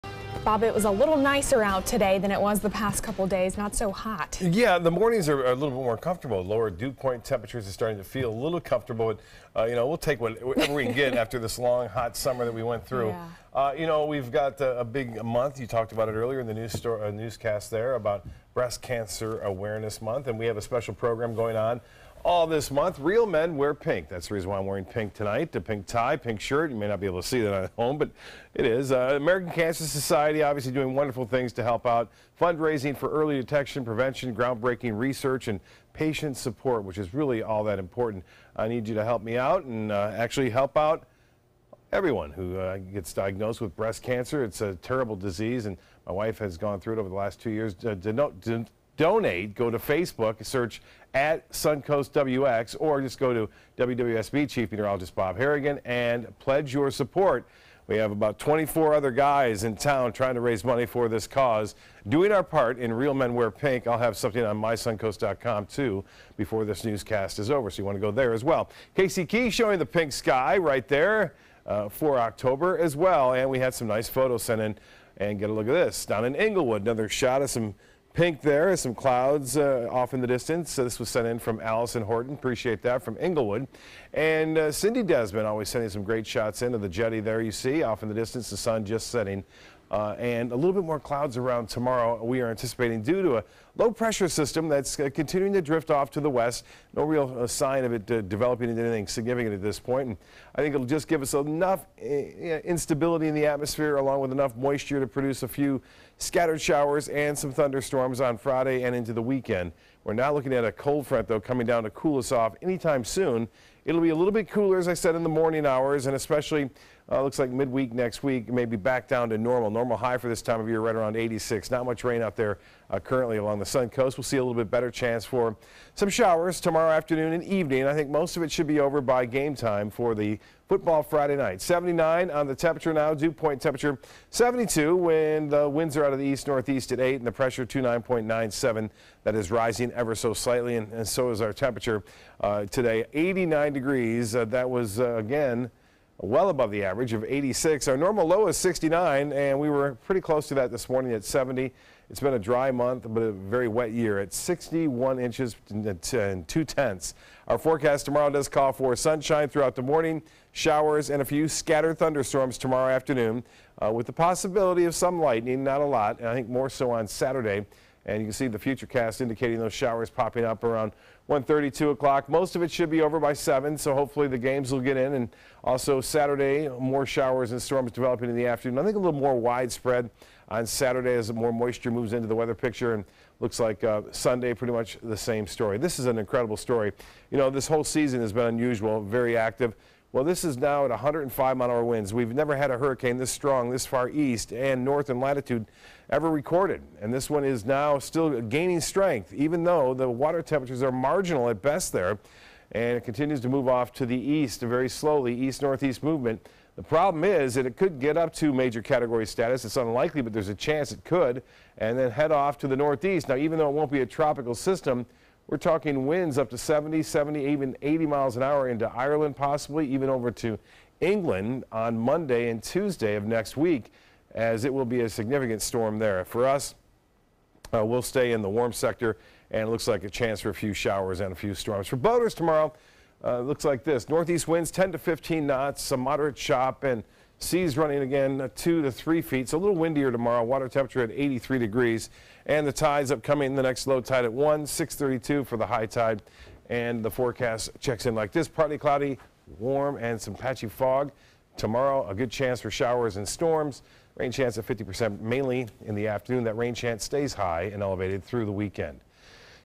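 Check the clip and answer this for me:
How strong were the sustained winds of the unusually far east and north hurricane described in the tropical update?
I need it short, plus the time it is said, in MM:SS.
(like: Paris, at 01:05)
105 mph, at 03:10.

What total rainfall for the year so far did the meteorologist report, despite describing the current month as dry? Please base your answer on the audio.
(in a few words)
61.2 inches.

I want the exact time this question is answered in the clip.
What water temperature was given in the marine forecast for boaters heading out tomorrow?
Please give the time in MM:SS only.
04:01.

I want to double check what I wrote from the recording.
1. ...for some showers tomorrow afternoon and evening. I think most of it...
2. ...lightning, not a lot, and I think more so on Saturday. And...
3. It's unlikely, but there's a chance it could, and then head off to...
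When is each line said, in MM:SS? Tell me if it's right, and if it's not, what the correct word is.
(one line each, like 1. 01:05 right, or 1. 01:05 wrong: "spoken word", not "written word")
1. 02:05 right
2. 02:45 right
3. 03:29 right.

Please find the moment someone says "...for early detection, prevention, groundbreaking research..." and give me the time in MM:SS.
00:32.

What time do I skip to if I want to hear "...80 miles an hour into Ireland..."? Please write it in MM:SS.
03:37.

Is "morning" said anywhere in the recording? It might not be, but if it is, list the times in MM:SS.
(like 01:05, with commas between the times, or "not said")
00:04, 01:55, 02:30, 02:39.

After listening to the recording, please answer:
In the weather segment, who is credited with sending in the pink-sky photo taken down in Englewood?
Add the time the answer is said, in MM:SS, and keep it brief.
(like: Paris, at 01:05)
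Allison Horton, at 01:21.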